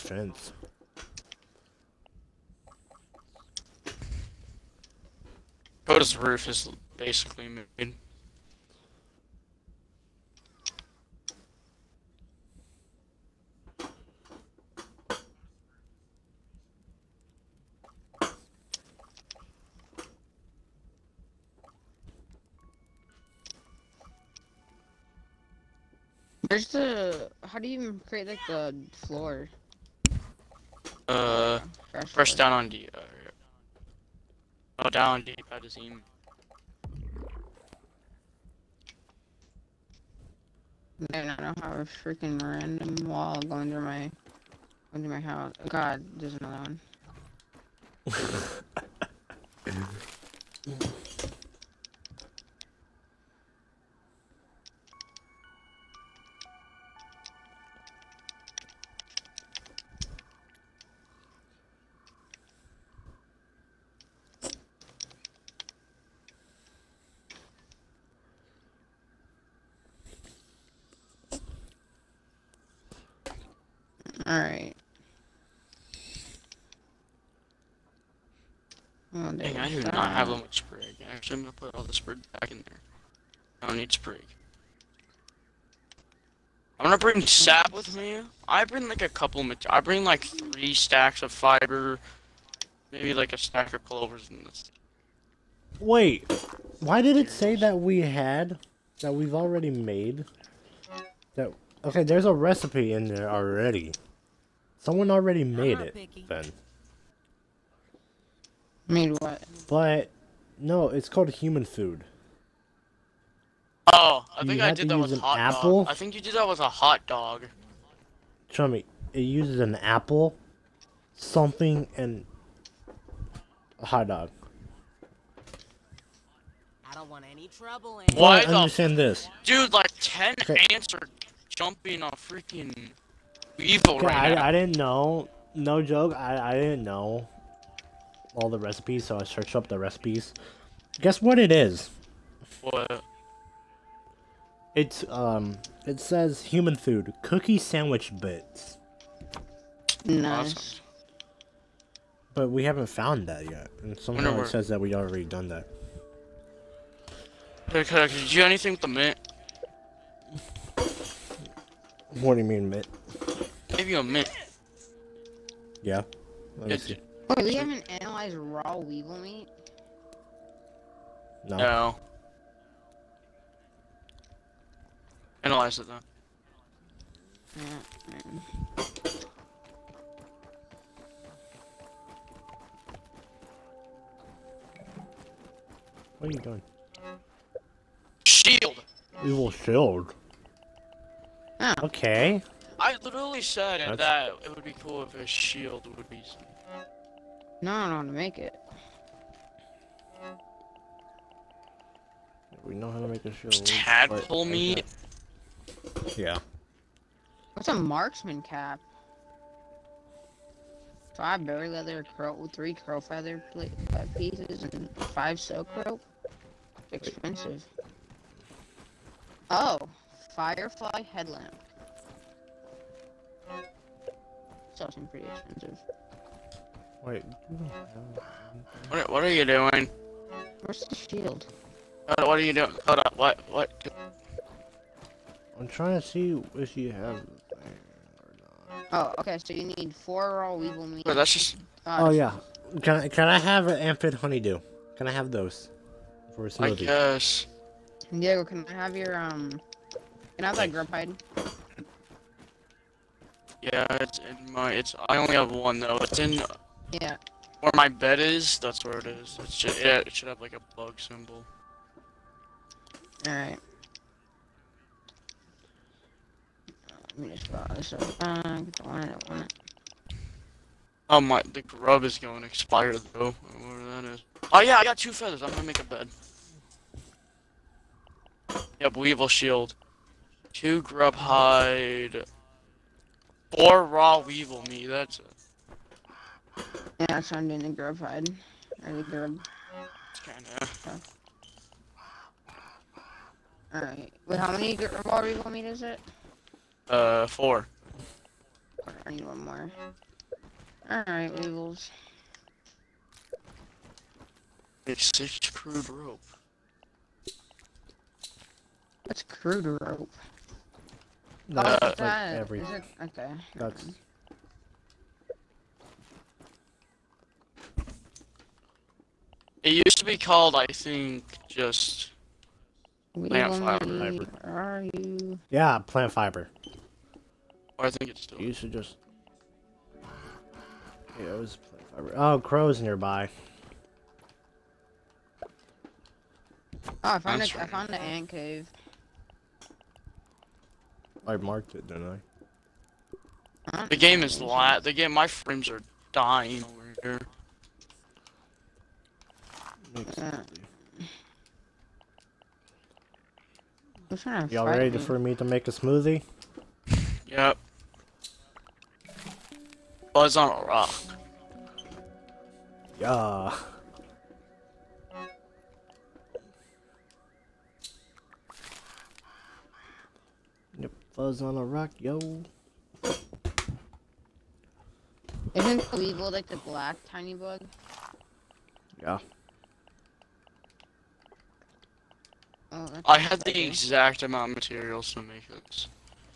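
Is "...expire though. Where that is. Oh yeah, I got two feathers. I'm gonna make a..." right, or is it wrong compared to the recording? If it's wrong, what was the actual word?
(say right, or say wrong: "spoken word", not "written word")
right.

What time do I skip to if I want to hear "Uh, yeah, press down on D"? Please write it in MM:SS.
00:31.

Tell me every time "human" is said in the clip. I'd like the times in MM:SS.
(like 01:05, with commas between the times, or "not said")
01:51, 02:26.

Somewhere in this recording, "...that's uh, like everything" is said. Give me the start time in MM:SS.
05:11.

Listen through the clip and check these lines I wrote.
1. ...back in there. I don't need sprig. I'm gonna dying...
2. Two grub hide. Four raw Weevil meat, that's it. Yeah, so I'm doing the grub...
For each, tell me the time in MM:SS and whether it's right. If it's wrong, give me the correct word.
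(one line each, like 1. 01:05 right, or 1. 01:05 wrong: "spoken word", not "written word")
1. 01:22 wrong: "bring", not "dying"
2. 04:40 right.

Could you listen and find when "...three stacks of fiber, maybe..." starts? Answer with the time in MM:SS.
01:30.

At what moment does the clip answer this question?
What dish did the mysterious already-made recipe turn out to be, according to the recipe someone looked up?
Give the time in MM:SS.
02:27.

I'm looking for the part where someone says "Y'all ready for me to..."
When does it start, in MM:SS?
05:54.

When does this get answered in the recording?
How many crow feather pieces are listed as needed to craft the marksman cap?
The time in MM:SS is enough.
03:32.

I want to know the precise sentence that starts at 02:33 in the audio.
And somehow it says that we already done that.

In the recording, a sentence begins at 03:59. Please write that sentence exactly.
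Oh, okay, so you need four raw weevil meat.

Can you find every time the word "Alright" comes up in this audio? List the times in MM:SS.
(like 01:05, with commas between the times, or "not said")
04:23, 04:53, 05:00.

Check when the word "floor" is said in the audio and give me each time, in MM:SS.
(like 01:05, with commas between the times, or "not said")
00:28.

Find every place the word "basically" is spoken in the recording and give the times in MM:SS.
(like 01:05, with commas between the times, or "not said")
00:06.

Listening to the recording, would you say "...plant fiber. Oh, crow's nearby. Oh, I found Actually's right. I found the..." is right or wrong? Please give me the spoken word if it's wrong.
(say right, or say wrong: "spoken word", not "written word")
wrong: "That", not "Actually".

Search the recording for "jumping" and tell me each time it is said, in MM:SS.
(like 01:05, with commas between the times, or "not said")
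02:11.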